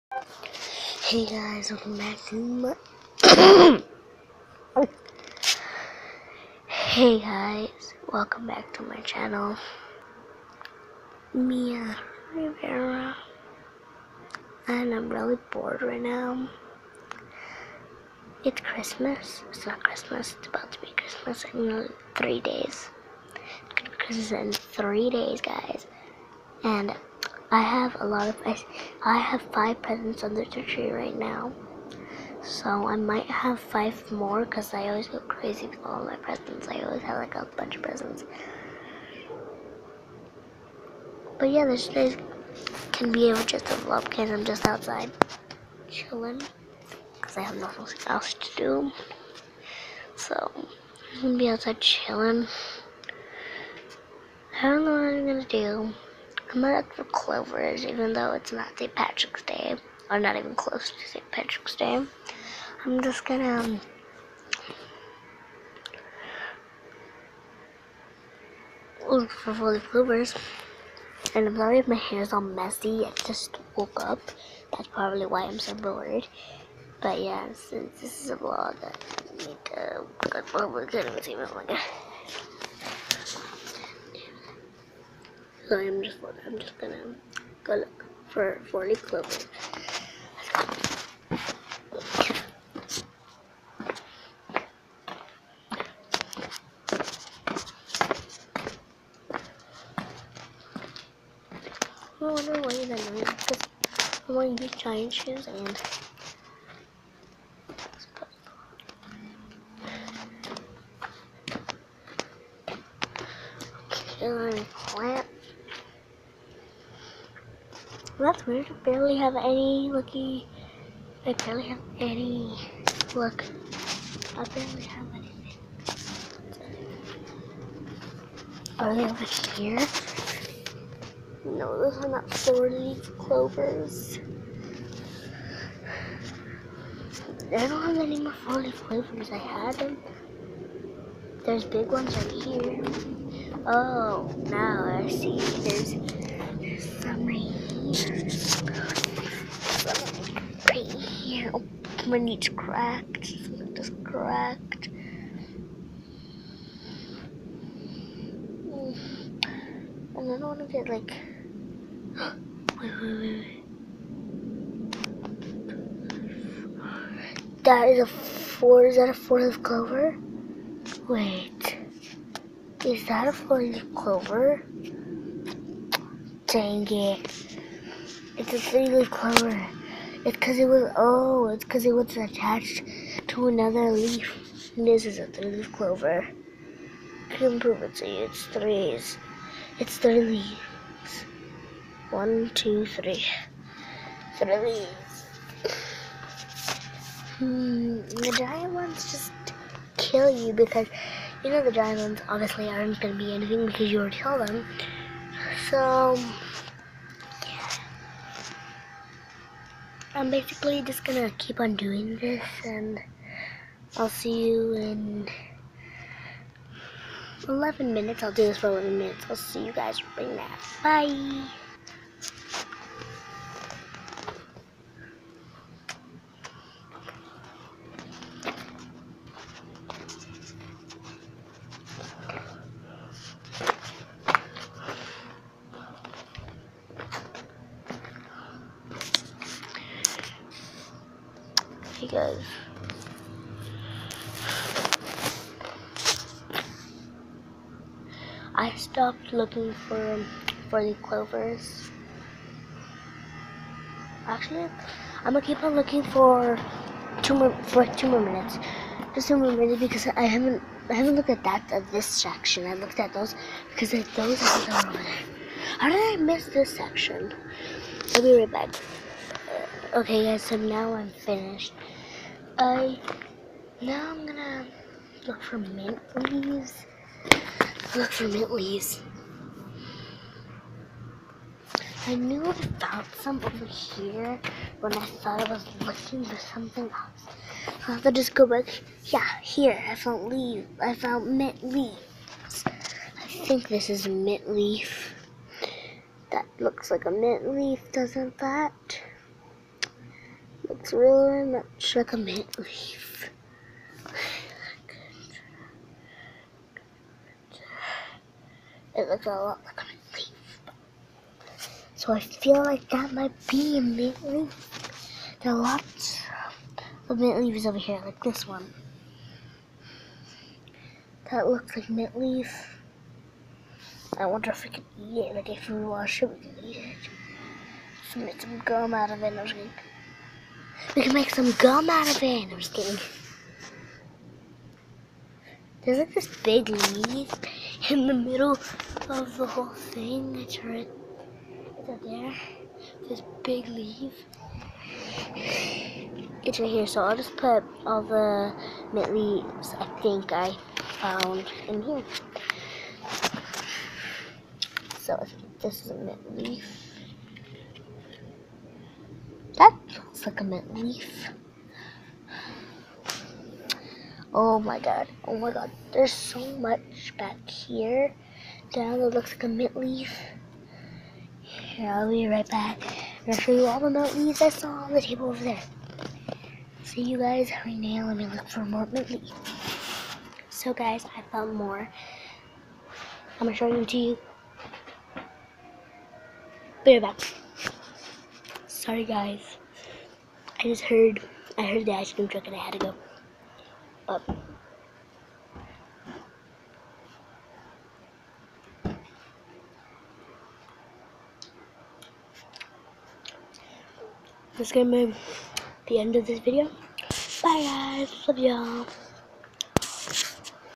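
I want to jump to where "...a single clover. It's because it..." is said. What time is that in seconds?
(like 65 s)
178 s.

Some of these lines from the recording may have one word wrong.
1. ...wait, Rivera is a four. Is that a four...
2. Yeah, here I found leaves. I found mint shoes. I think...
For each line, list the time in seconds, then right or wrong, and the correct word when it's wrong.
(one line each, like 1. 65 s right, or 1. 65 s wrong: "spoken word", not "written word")
1. 163 s wrong: "That", not "Rivera"
2. 289 s wrong: "leaves", not "shoes".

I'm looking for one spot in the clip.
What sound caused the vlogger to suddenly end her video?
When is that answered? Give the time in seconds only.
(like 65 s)
391 s.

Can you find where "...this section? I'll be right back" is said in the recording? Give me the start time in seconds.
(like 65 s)
266 s.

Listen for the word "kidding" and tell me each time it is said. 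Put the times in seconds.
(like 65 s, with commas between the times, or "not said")
332 s.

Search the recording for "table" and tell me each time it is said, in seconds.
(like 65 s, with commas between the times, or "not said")
375 s.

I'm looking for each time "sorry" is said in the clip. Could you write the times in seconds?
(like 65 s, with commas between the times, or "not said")
71 s, 388 s.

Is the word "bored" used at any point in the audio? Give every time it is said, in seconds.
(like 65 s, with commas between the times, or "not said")
15 s, 75 s.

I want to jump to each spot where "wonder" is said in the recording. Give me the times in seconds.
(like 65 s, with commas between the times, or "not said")
102 s, 324 s.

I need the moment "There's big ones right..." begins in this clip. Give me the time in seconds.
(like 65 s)
141 s.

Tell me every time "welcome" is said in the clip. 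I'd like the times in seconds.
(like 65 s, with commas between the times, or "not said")
1 s, 8 s.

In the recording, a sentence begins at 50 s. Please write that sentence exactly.
So I'm gonna be outside chilling.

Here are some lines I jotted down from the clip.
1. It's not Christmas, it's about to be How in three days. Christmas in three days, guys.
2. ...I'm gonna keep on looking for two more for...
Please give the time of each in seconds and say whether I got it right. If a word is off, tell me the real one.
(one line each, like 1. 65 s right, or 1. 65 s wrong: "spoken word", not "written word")
1. 19 s wrong: "Christmas", not "How"
2. 255 s right.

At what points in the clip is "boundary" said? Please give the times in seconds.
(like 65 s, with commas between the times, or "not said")
not said.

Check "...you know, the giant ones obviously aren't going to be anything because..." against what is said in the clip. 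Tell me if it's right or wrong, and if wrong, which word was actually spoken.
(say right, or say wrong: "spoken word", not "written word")
right.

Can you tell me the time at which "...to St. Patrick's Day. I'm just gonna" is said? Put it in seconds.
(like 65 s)
60 s.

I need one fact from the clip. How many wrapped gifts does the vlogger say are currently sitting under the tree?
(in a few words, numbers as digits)
5.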